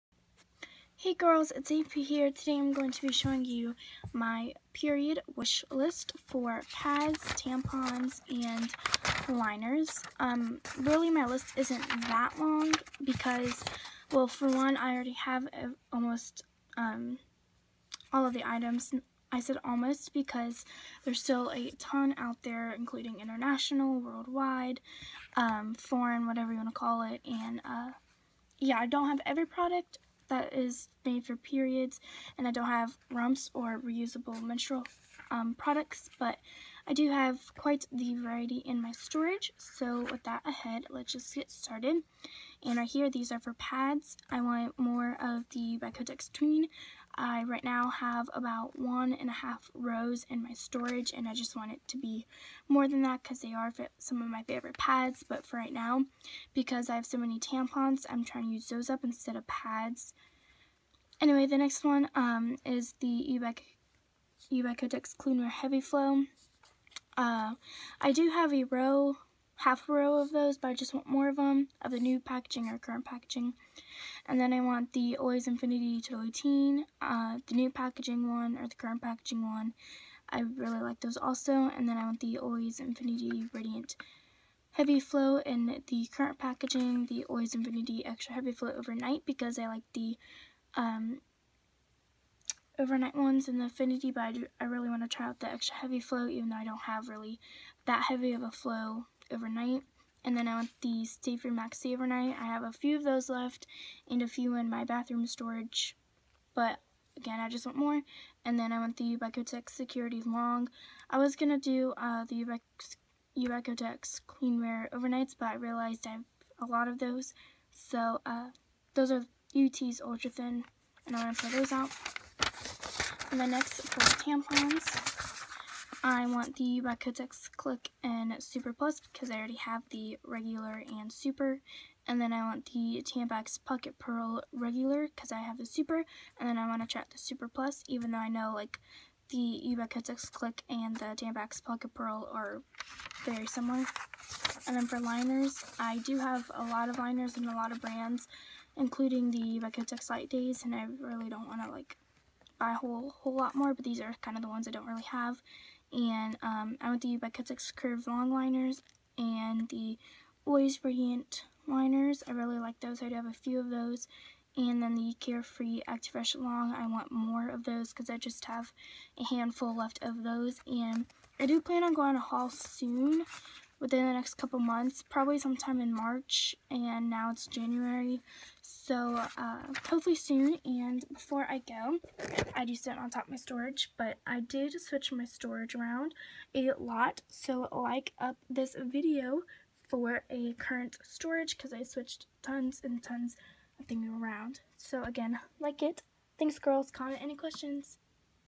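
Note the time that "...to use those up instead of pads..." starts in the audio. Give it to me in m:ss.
0:58.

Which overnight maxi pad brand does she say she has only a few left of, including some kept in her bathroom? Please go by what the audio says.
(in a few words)
Stay Free.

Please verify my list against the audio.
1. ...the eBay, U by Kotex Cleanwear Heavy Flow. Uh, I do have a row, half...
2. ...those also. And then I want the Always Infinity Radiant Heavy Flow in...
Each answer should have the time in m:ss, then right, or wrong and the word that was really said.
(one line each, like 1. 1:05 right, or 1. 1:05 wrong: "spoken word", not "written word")
1. 1:02 right
2. 1:21 right.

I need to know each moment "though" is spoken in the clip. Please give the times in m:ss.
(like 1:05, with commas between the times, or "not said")
1:36, 2:18.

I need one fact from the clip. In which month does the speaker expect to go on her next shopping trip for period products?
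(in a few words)
March.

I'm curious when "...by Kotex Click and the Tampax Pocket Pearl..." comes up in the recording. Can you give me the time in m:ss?
2:19.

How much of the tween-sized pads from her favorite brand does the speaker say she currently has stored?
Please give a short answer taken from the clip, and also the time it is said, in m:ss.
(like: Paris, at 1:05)
1.5 rows, at 0:48.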